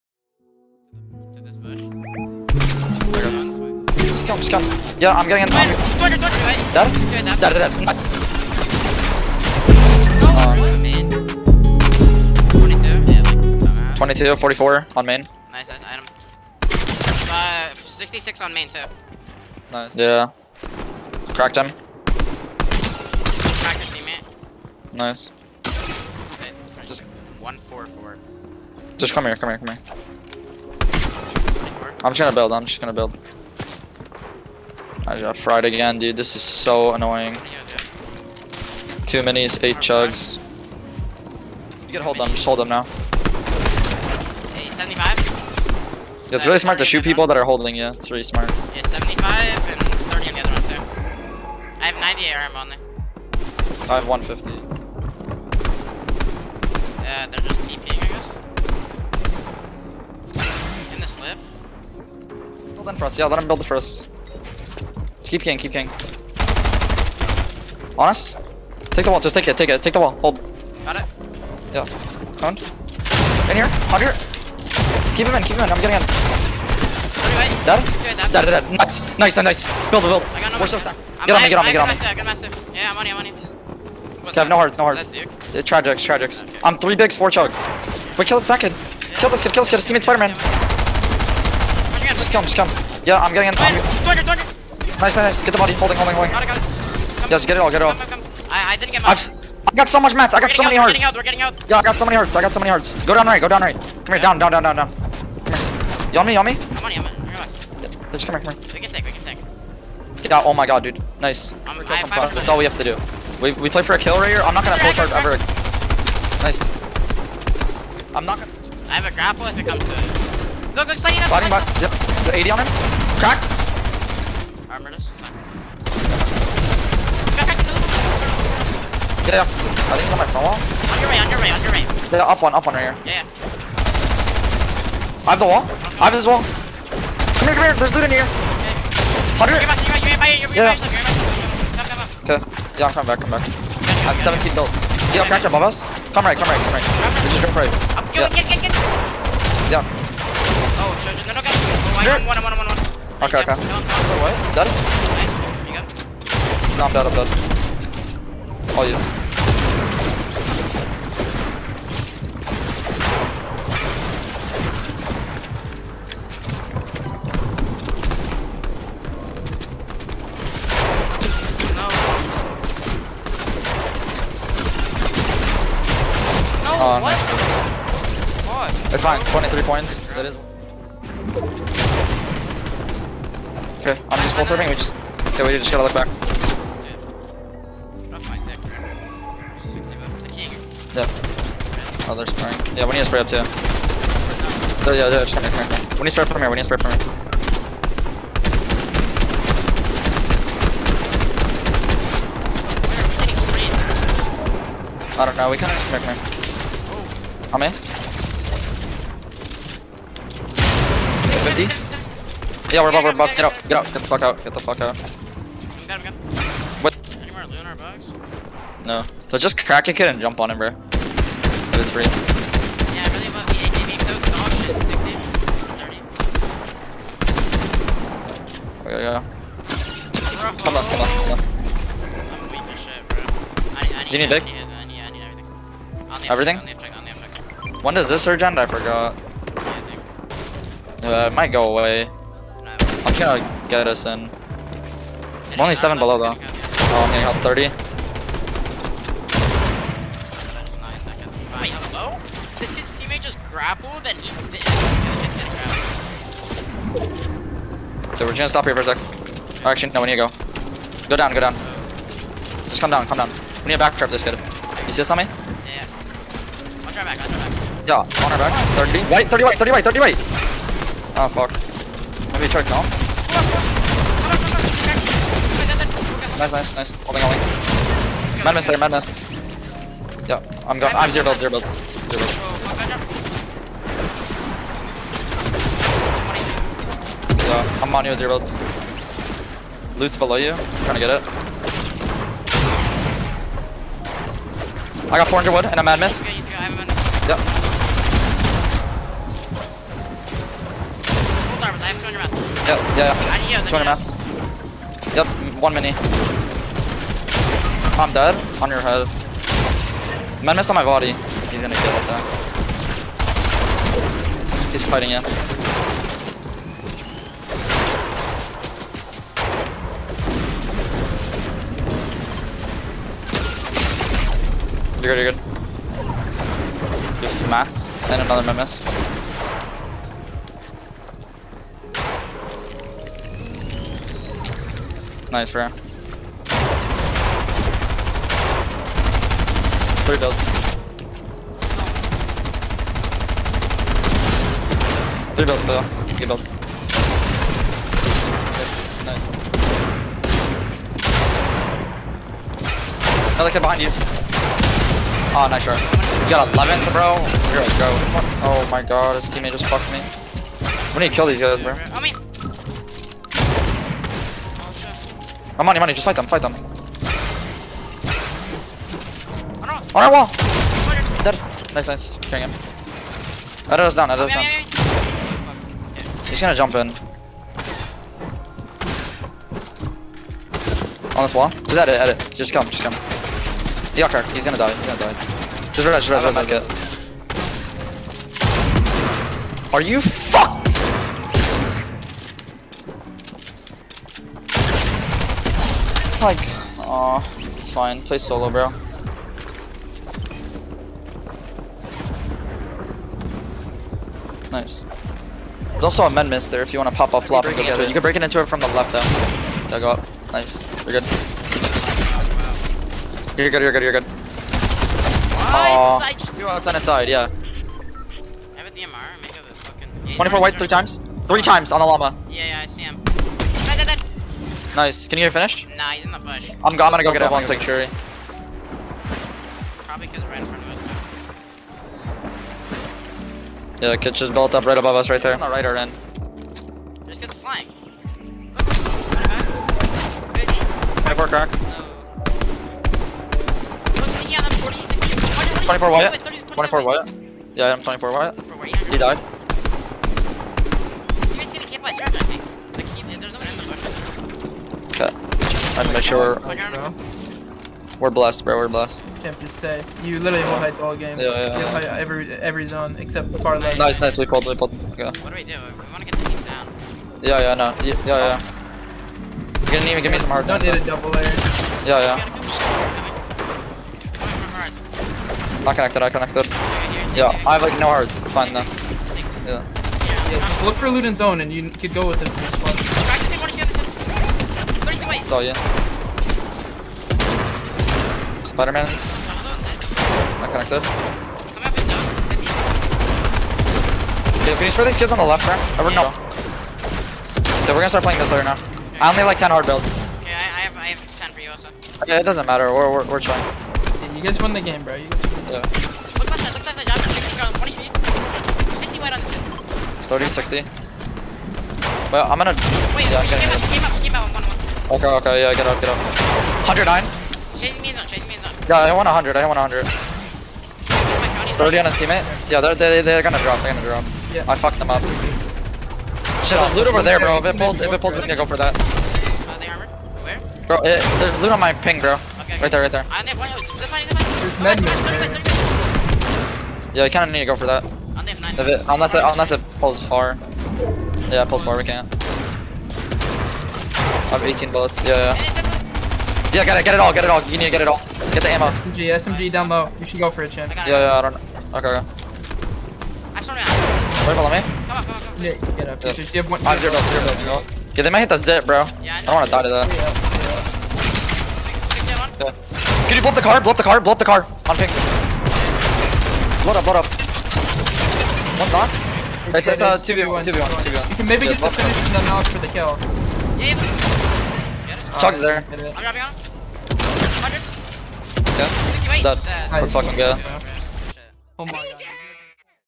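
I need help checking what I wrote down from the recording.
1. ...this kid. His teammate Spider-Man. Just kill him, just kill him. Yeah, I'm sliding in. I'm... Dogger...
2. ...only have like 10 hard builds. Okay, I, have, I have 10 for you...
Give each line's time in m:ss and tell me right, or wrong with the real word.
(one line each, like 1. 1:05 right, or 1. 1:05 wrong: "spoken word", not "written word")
1. 1:29 wrong: "getting", not "sliding"
2. 8:19 right.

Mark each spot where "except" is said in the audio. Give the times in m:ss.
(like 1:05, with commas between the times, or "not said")
7:42.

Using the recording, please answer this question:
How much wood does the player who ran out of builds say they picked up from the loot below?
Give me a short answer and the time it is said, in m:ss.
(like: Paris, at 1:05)
400, at 4:55.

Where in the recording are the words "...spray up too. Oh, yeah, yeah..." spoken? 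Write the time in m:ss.
3:13.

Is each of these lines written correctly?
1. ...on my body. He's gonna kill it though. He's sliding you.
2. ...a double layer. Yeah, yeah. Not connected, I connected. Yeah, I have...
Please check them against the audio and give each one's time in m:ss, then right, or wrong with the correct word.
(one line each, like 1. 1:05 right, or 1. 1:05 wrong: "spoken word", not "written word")
1. 5:10 wrong: "fighting", not "sliding"
2. 7:50 right.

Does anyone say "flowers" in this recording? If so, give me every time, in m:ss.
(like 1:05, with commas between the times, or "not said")
not said.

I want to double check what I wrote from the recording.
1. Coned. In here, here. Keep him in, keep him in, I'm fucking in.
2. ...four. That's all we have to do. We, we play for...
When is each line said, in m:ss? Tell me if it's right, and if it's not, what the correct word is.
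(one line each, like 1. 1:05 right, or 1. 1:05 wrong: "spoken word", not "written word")
1. 1:12 wrong: "getting", not "fucking"
2. 1:52 wrong: "five", not "four".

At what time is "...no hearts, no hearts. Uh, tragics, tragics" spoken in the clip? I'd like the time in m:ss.
1:24.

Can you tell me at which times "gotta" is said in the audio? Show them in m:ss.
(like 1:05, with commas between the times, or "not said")
0:41, 3:05.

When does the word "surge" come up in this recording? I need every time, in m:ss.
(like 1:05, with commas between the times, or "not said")
3:58.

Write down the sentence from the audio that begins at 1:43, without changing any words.
Come here, down, down, down, down, down.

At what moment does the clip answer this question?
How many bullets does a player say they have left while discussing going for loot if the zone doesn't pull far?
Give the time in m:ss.
9:03.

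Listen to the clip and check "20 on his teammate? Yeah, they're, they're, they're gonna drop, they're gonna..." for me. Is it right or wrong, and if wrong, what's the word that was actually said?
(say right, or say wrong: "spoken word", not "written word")
wrong: "30", not "20".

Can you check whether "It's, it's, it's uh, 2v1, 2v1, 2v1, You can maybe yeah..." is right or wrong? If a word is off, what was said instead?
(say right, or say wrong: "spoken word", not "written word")
right.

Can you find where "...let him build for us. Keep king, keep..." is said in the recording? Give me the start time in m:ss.
1:03.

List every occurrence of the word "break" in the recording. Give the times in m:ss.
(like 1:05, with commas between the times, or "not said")
6:48.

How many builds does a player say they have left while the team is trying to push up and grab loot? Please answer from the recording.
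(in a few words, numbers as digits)
17.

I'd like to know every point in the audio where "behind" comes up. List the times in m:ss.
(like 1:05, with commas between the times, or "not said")
5:53.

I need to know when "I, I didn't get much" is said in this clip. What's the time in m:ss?
1:38.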